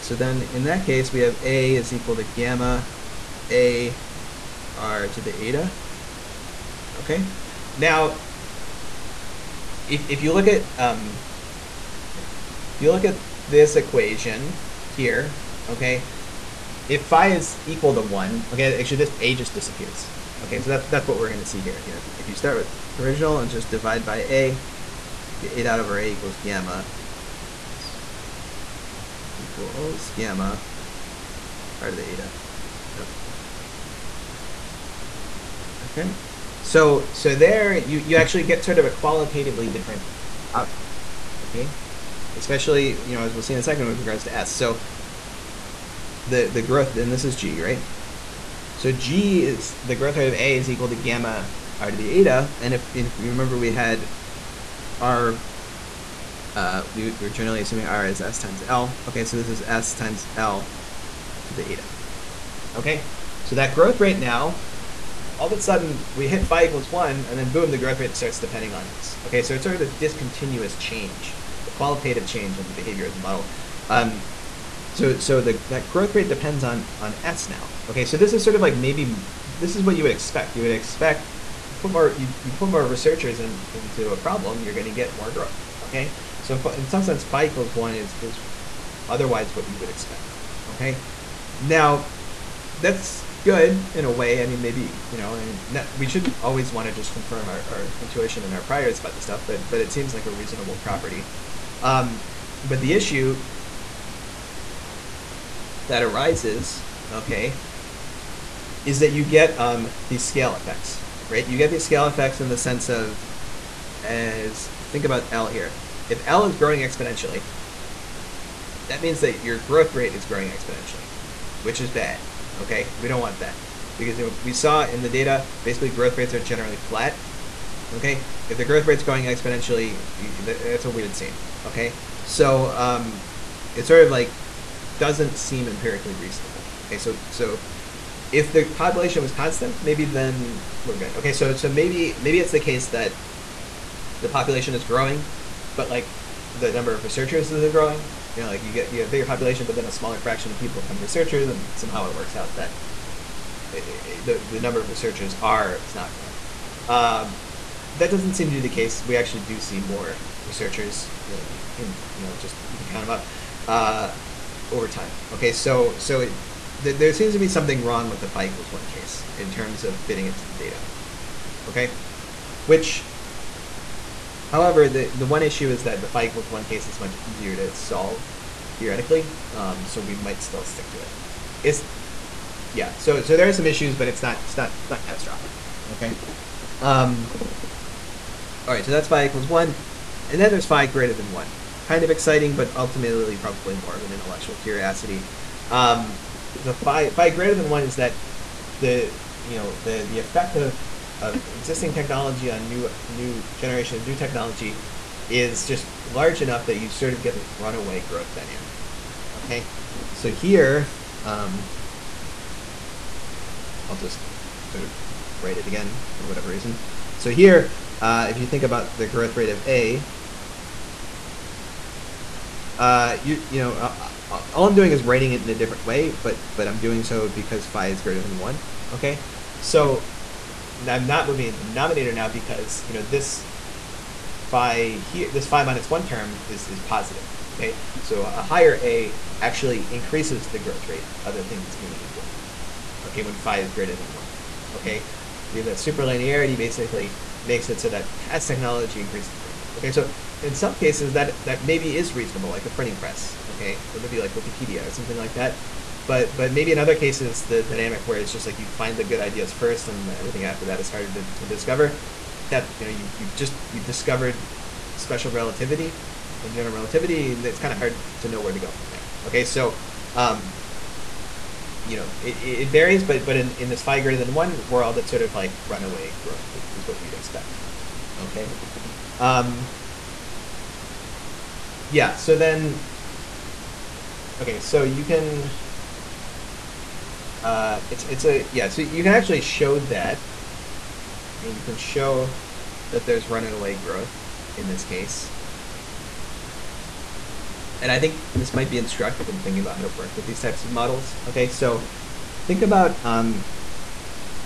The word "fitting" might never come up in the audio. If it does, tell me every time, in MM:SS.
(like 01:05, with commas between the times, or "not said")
02:50.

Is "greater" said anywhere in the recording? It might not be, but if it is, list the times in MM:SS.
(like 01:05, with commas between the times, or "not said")
03:10, 03:17, 03:48, 04:03, 04:33.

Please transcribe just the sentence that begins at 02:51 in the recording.
Okay, which, however, the the one issue is that the phi equals one case is much easier to solve theoretically.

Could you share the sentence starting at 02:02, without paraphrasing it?
Okay, we don't want that because we saw in the data basically growth rates are generally flat.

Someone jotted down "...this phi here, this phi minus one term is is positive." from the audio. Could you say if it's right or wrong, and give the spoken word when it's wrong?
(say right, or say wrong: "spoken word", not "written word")
right.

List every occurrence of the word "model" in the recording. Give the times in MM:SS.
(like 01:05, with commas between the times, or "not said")
01:13, 05:00.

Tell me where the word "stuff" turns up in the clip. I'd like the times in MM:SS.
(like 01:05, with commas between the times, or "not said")
01:39.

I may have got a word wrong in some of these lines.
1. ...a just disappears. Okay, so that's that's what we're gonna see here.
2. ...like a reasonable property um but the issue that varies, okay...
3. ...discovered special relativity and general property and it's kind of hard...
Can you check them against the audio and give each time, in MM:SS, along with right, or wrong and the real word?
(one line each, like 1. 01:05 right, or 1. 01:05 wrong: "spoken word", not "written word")
1. 00:19 right
2. 01:40 wrong: "arises", not "varies"
3. 04:23 wrong: "relativity", not "property".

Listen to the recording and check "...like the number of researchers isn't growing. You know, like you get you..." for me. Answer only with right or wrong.
right.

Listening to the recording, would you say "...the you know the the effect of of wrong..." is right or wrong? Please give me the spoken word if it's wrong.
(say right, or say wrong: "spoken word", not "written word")
wrong: "existing", not "wrong".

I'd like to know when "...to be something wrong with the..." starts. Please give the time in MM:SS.
02:47.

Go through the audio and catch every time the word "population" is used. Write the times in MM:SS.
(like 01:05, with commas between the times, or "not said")
02:18, 02:24, 02:29.